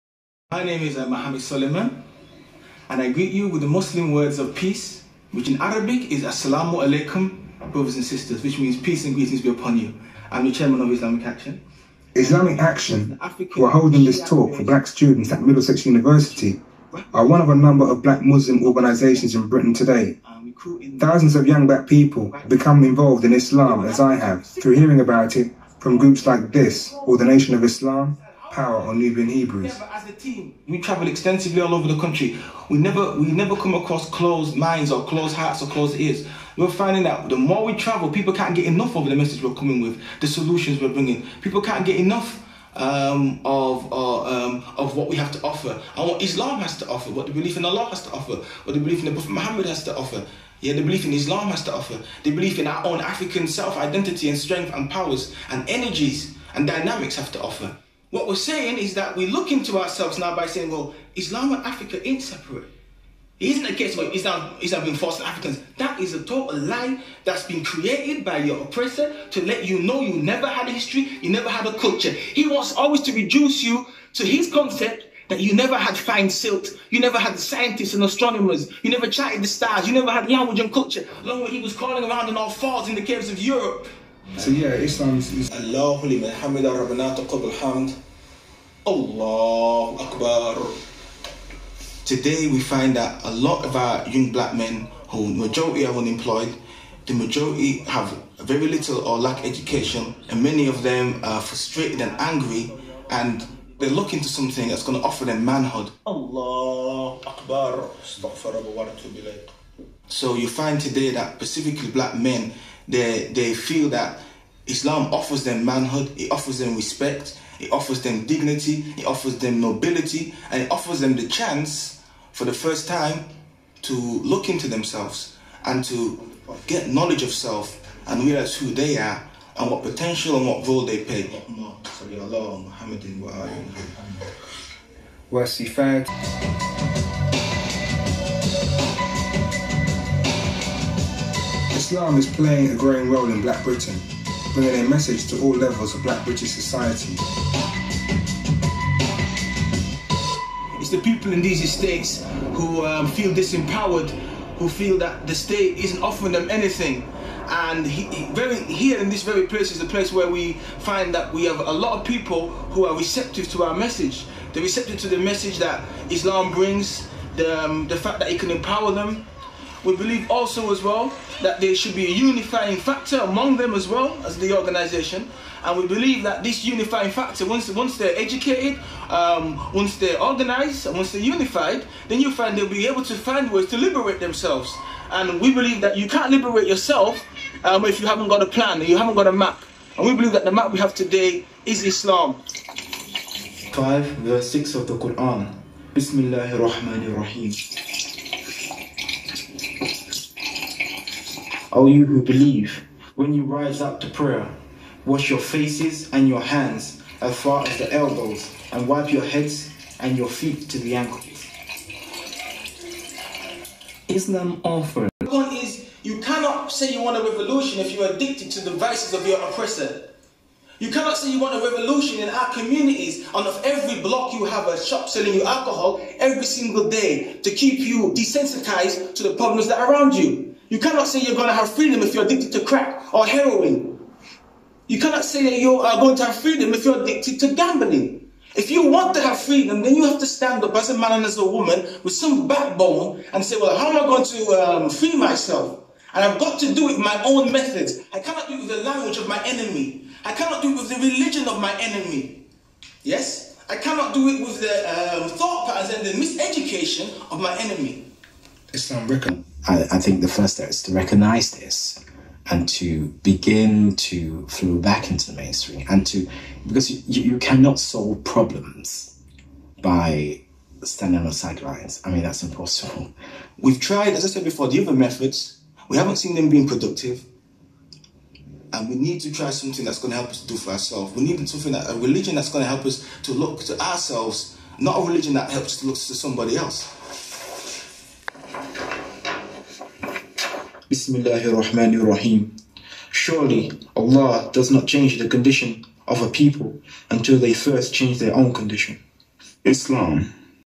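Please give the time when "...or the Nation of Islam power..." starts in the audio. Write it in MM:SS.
00:27.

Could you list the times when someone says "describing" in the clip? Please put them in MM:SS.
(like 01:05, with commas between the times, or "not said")
not said.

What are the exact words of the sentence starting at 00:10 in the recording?
I'm the chairman of Islamic Action.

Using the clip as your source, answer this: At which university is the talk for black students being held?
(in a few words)
Middlesex University.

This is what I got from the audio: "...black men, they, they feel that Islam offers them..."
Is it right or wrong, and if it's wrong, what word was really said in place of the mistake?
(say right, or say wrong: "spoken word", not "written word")
right.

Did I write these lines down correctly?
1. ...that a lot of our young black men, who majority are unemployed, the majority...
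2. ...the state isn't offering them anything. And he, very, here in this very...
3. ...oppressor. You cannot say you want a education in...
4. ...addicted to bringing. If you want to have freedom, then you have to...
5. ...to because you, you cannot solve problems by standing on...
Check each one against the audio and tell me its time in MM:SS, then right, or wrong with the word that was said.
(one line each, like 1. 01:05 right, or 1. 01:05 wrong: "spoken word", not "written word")
1. 01:32 right
2. 02:35 right
3. 03:39 wrong: "revolution", not "education"
4. 03:57 wrong: "gambling", not "bringing"
5. 04:26 right.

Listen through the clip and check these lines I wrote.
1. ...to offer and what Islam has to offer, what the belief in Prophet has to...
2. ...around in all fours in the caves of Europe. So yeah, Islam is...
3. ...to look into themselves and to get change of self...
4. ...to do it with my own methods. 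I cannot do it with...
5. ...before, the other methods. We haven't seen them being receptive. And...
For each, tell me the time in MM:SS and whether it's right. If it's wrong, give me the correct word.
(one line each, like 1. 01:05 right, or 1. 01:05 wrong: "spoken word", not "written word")
1. 00:45 wrong: "Allah", not "Prophet"
2. 01:22 right
3. 02:03 wrong: "knowledge", not "change"
4. 04:06 right
5. 04:34 wrong: "productive", not "receptive".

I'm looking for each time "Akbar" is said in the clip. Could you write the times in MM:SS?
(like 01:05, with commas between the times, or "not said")
01:30, 01:47.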